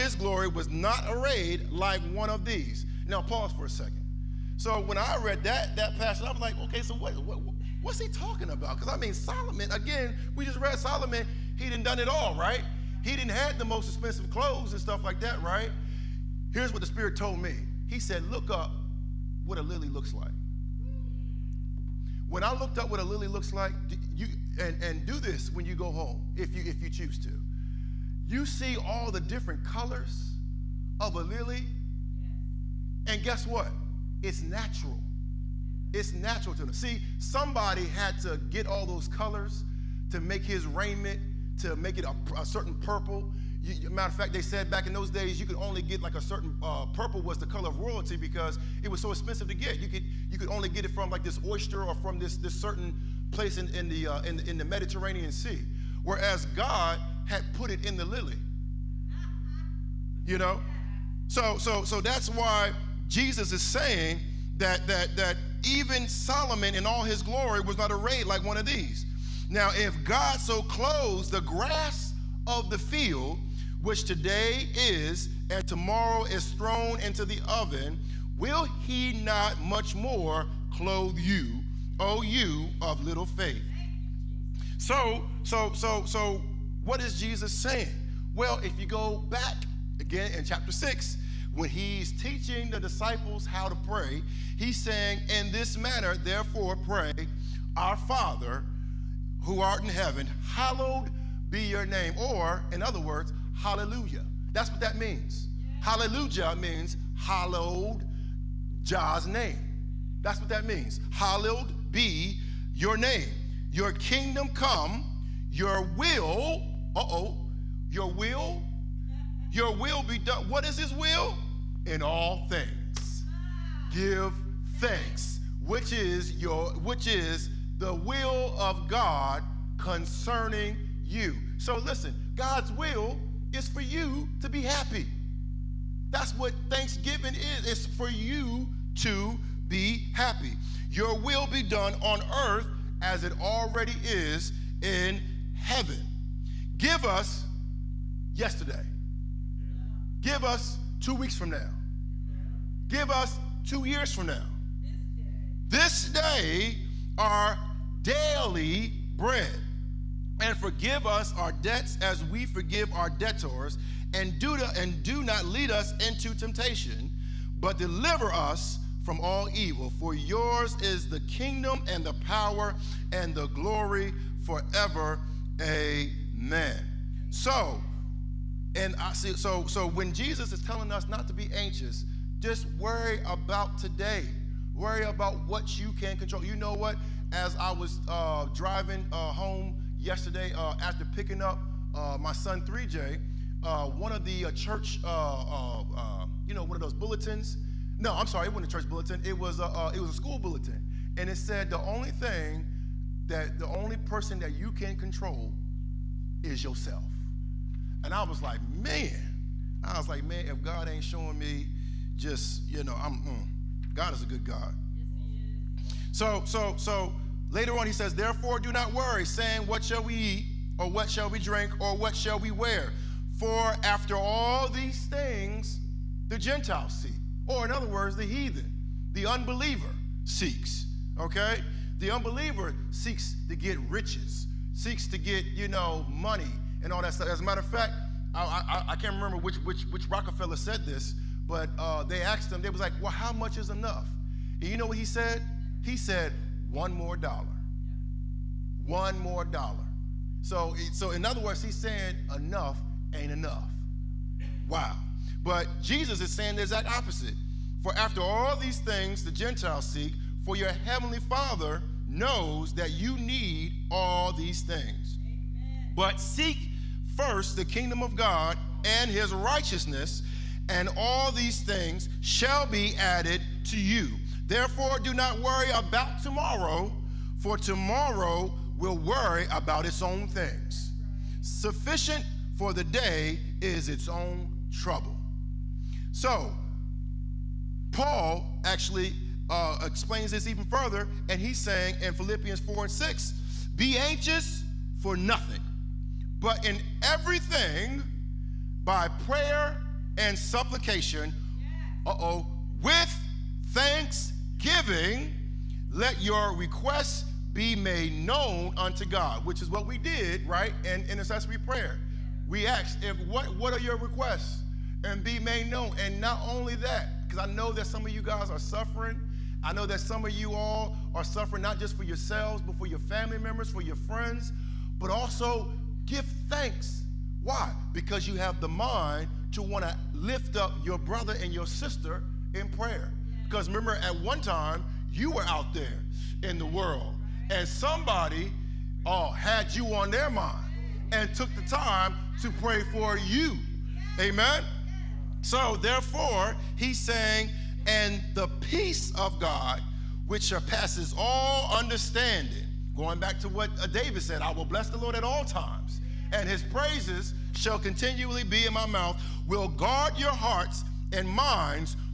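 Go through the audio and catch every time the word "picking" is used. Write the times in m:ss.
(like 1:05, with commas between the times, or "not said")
3:11.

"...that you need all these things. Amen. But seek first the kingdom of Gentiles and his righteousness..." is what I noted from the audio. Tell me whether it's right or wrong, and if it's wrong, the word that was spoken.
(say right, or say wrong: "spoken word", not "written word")
wrong: "God", not "Gentiles".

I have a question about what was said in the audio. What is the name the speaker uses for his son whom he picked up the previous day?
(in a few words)
3J.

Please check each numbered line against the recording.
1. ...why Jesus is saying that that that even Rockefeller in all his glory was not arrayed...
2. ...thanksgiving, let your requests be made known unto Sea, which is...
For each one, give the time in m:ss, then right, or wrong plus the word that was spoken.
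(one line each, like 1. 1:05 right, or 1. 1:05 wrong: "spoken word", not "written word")
1. 1:02 wrong: "Solomon", not "Rockefeller"
2. 5:03 wrong: "God", not "Sea".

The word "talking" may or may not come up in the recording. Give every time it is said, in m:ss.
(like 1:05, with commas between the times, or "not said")
0:08.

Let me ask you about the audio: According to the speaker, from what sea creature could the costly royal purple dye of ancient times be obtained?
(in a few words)
oyster.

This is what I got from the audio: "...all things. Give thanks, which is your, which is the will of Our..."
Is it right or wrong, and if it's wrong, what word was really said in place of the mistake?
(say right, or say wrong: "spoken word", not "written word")
wrong: "God", not "Our".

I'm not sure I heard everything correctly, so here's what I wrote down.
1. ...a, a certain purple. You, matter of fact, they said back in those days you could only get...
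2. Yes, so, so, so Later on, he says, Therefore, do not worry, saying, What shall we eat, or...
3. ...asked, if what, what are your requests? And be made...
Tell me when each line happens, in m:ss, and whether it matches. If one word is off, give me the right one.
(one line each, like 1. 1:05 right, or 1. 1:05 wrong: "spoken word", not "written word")
1. 0:42 right
2. 3:34 right
3. 5:12 right.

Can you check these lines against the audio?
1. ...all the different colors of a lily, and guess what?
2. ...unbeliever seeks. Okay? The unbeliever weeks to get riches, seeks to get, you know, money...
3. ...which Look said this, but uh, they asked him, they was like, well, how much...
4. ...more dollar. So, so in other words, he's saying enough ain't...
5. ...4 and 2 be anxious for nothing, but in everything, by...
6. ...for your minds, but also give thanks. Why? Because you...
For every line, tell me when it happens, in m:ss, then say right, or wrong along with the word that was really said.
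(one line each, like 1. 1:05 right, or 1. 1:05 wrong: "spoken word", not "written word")
1. 0:28 right
2. 3:49 wrong: "seeks", not "weeks"
3. 3:59 wrong: "Rockefeller", not "Look"
4. 4:09 right
5. 4:52 wrong: "6", not "2"
6. 5:23 wrong: "friends", not "minds".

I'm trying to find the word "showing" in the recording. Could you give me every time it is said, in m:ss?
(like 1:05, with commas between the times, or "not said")
3:31.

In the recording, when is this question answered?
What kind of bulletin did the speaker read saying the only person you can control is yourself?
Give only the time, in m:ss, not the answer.
3:20.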